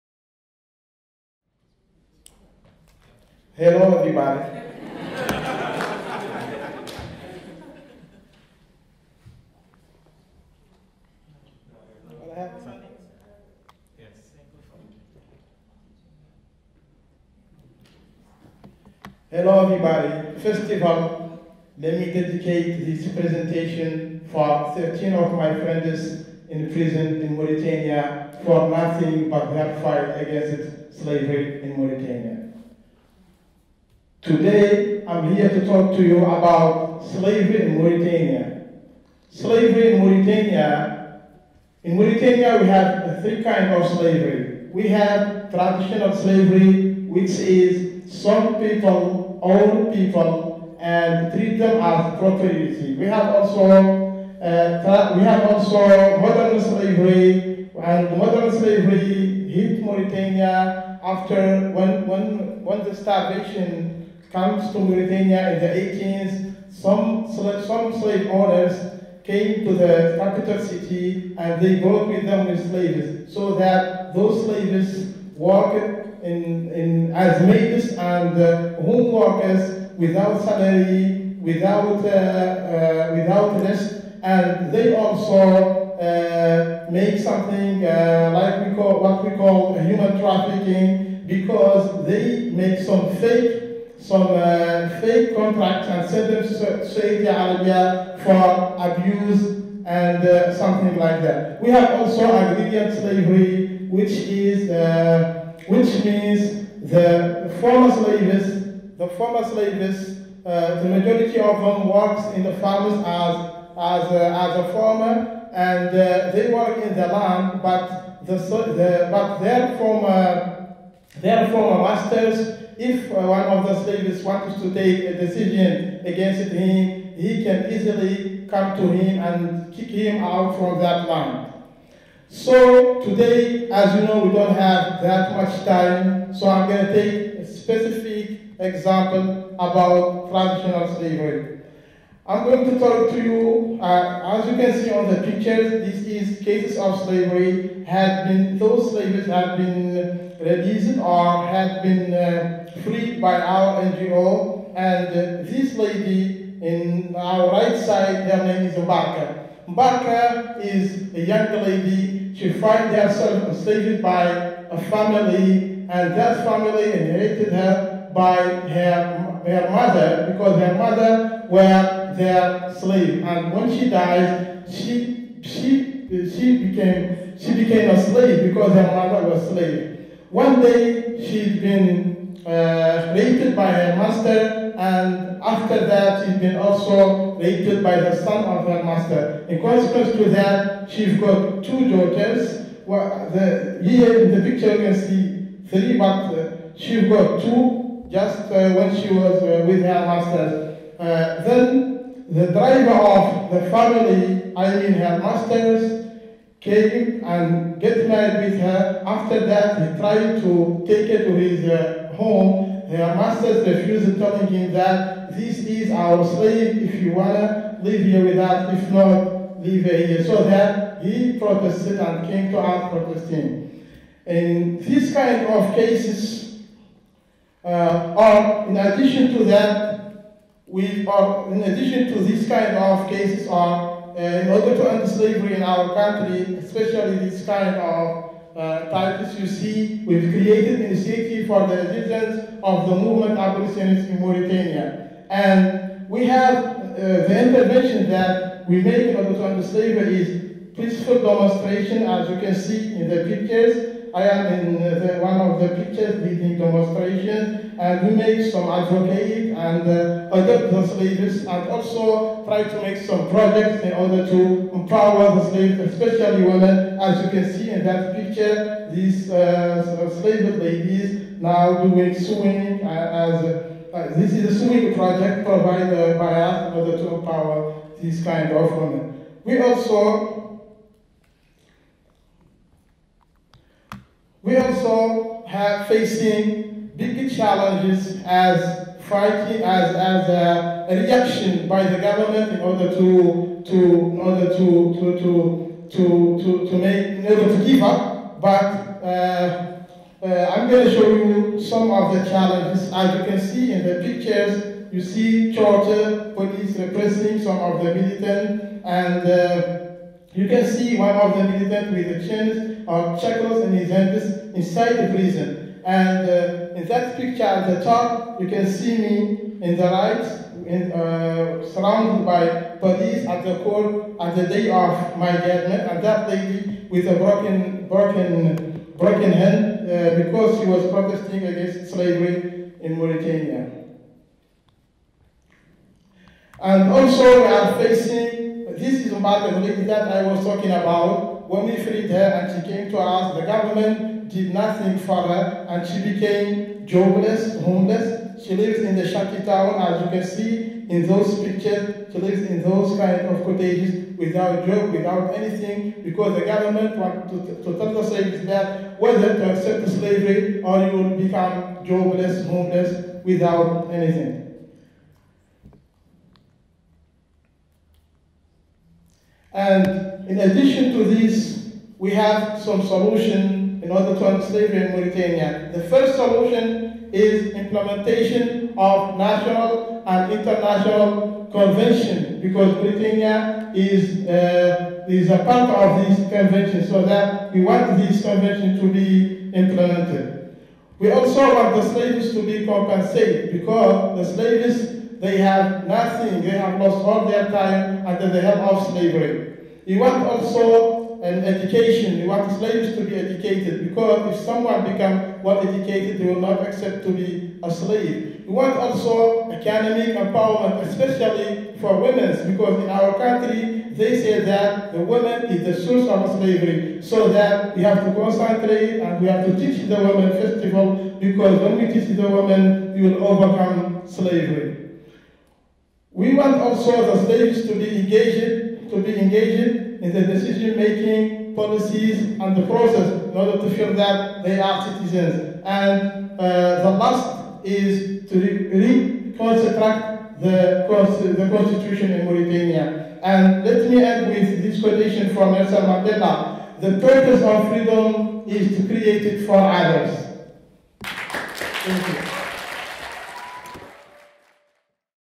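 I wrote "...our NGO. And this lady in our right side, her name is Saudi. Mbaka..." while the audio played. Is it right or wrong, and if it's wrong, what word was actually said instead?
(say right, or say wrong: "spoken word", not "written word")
wrong: "Mbaka", not "Saudi".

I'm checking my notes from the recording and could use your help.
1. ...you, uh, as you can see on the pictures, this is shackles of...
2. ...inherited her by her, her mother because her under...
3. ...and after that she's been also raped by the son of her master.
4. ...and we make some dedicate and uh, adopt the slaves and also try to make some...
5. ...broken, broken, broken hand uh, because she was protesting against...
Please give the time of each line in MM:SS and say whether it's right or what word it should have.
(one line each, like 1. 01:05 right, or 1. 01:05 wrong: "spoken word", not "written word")
1. 02:23 wrong: "cases", not "shackles"
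2. 02:46 wrong: "mother", not "under"
3. 03:04 right
4. 04:17 wrong: "advocate", not "dedicate"
5. 05:27 right.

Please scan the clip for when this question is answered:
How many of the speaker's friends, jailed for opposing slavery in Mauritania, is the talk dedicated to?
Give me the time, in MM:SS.
00:24.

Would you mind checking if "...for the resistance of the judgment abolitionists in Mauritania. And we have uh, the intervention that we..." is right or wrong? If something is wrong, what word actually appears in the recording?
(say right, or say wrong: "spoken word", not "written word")
wrong: "movement", not "judgment".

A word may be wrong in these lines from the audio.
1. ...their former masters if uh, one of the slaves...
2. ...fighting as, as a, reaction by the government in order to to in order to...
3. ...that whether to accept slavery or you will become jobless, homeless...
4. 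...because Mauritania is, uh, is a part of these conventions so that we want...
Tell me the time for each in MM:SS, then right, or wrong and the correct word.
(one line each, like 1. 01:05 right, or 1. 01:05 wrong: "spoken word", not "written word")
1. 02:01 right
2. 04:49 right
3. 05:58 right
4. 06:22 right.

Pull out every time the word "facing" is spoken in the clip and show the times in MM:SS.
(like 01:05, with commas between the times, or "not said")
04:45, 05:37.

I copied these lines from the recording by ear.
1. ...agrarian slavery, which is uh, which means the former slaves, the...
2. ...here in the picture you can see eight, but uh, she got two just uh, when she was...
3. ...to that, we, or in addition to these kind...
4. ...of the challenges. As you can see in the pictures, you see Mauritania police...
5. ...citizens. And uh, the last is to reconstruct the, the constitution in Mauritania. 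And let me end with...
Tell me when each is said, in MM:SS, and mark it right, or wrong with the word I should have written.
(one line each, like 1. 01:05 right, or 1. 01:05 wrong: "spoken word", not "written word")
1. 01:42 right
2. 03:13 wrong: "three", not "eight"
3. 03:49 right
4. 05:01 wrong: "Georgia", not "Mauritania"
5. 07:14 right.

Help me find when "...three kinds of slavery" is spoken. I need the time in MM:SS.
00:43.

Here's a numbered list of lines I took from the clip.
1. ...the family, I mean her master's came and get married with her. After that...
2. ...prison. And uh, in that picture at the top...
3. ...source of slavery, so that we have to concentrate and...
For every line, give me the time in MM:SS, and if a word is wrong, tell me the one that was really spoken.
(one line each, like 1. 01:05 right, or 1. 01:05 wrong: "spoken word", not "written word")
1. 03:23 right
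2. 05:15 right
3. 06:55 right.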